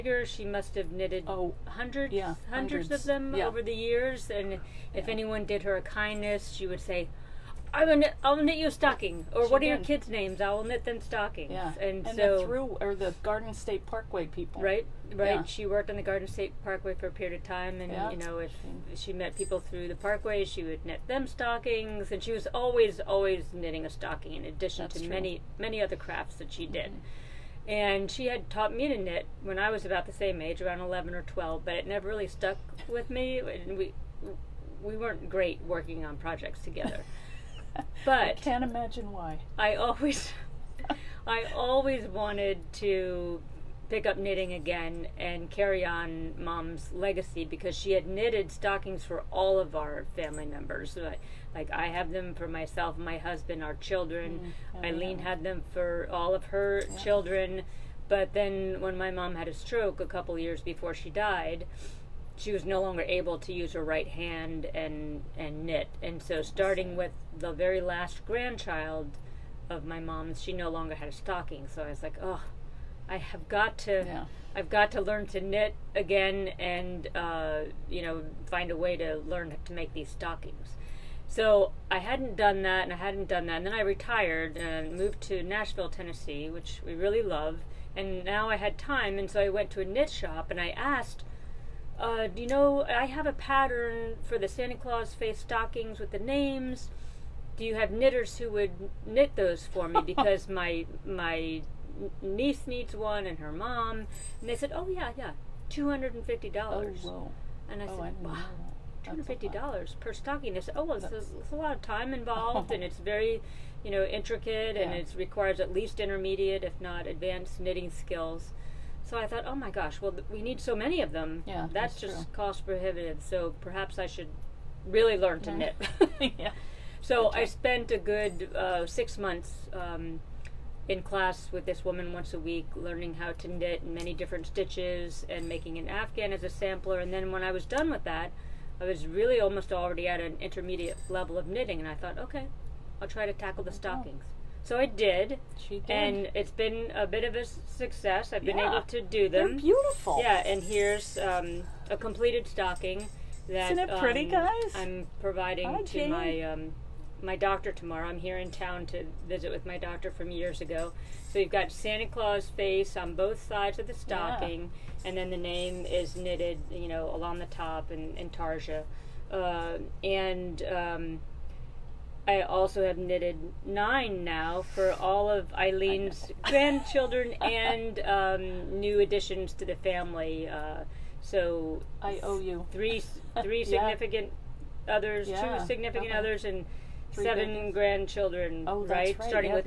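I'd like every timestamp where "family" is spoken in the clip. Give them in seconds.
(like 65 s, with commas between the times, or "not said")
50 s, 179 s.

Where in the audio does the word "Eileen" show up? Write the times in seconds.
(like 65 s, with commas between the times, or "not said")
54 s, 175 s.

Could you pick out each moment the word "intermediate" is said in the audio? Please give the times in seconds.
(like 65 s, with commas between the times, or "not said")
115 s, 140 s.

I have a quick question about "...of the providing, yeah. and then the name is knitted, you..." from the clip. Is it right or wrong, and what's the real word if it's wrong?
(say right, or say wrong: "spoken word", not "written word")
wrong: "stocking", not "providing".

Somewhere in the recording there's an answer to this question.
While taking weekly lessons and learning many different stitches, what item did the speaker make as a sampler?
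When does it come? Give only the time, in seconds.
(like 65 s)
135 s.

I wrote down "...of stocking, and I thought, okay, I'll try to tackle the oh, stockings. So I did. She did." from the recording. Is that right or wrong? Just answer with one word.
wrong.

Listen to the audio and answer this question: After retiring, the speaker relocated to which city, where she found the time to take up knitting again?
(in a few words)
Nashville.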